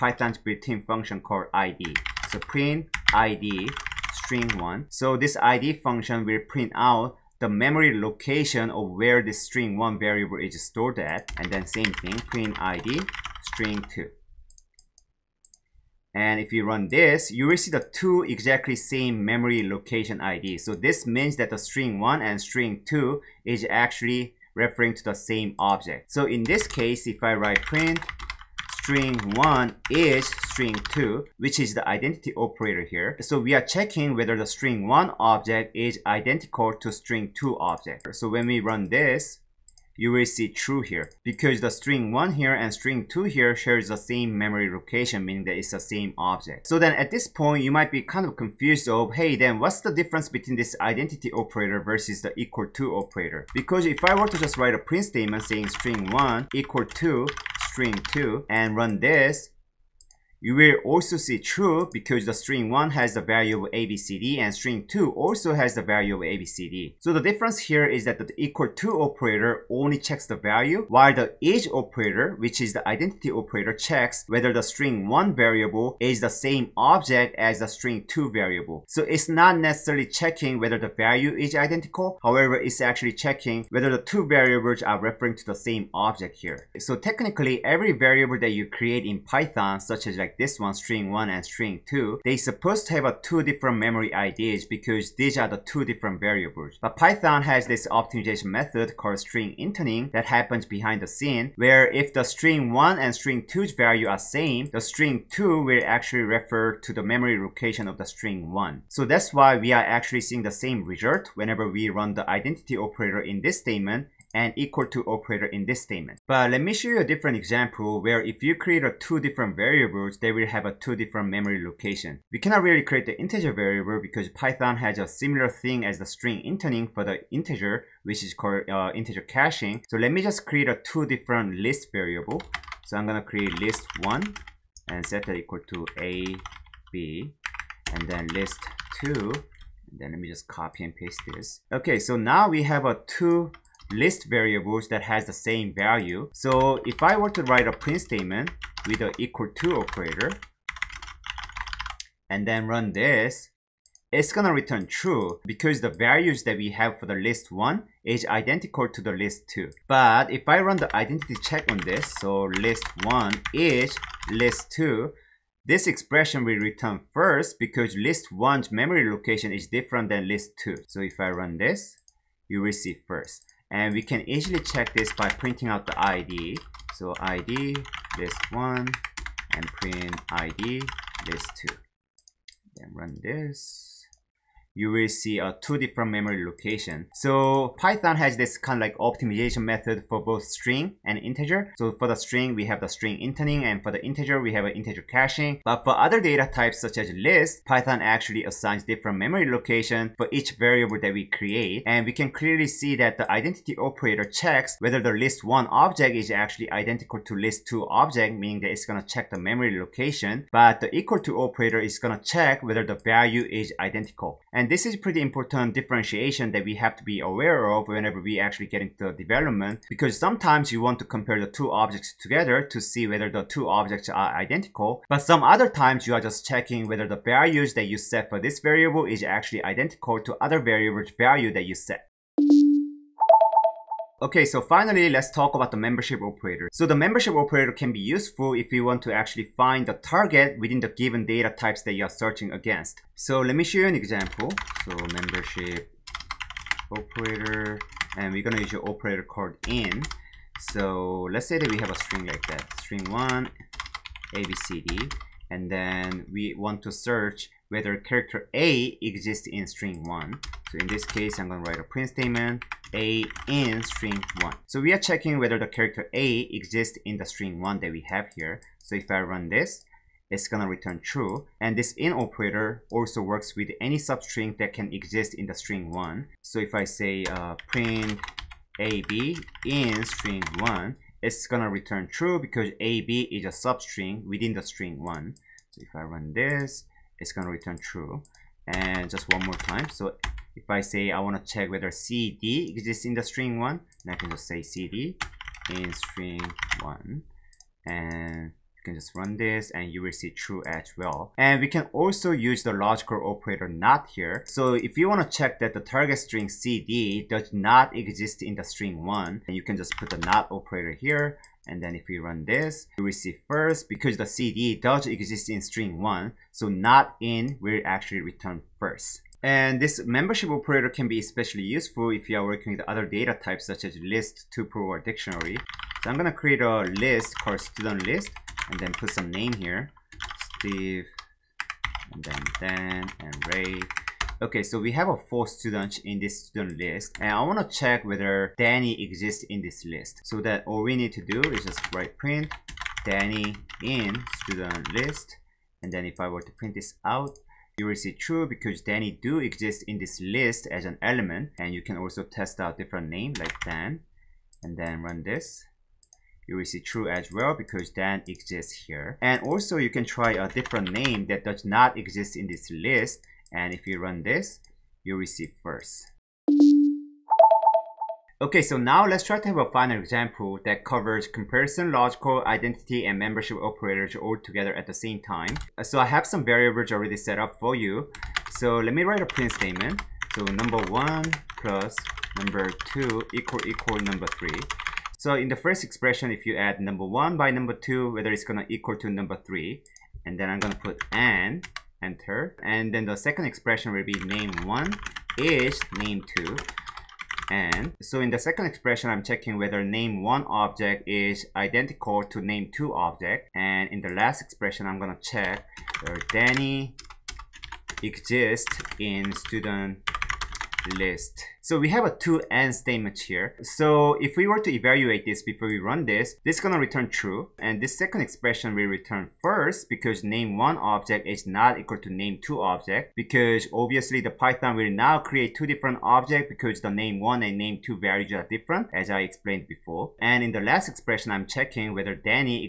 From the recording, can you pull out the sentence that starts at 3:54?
Okay, so finally, let's talk about the membership operator.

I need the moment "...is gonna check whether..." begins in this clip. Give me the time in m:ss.
3:31.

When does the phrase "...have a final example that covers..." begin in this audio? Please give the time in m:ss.
6:09.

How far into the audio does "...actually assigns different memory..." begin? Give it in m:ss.
3:18.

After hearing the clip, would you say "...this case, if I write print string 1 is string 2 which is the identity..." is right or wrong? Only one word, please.
right.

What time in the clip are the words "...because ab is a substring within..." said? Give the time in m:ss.
4:42.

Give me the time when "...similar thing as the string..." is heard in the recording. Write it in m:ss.
2:05.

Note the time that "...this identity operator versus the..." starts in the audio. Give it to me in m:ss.
0:50.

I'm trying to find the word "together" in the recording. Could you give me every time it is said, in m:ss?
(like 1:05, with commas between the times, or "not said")
3:42, 6:14.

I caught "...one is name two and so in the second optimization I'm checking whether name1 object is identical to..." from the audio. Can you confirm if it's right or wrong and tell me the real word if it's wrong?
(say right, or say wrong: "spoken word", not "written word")
wrong: "expression", not "optimization".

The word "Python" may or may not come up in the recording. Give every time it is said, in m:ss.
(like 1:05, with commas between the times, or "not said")
1:29, 1:36, 2:04, 3:07, 3:17, 7:04.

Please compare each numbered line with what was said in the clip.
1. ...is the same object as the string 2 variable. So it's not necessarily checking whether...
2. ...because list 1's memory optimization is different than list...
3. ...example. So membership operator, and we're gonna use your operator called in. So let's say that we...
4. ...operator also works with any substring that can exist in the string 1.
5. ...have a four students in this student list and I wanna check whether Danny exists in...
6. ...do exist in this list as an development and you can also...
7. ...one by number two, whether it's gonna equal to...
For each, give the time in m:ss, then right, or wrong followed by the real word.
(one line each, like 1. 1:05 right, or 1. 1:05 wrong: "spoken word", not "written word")
1. 1:15 right
2. 2:47 wrong: "location", not "optimization"
3. 4:03 right
4. 4:32 right
5. 5:34 right
6. 5:49 wrong: "element", not "development"
7. 6:27 right.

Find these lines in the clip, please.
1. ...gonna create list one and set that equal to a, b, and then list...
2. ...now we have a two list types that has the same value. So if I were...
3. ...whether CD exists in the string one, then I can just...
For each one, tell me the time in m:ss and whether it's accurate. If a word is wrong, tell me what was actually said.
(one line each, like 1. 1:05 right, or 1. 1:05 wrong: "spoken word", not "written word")
1. 2:13 right
2. 2:22 wrong: "variables", not "types"
3. 4:51 right.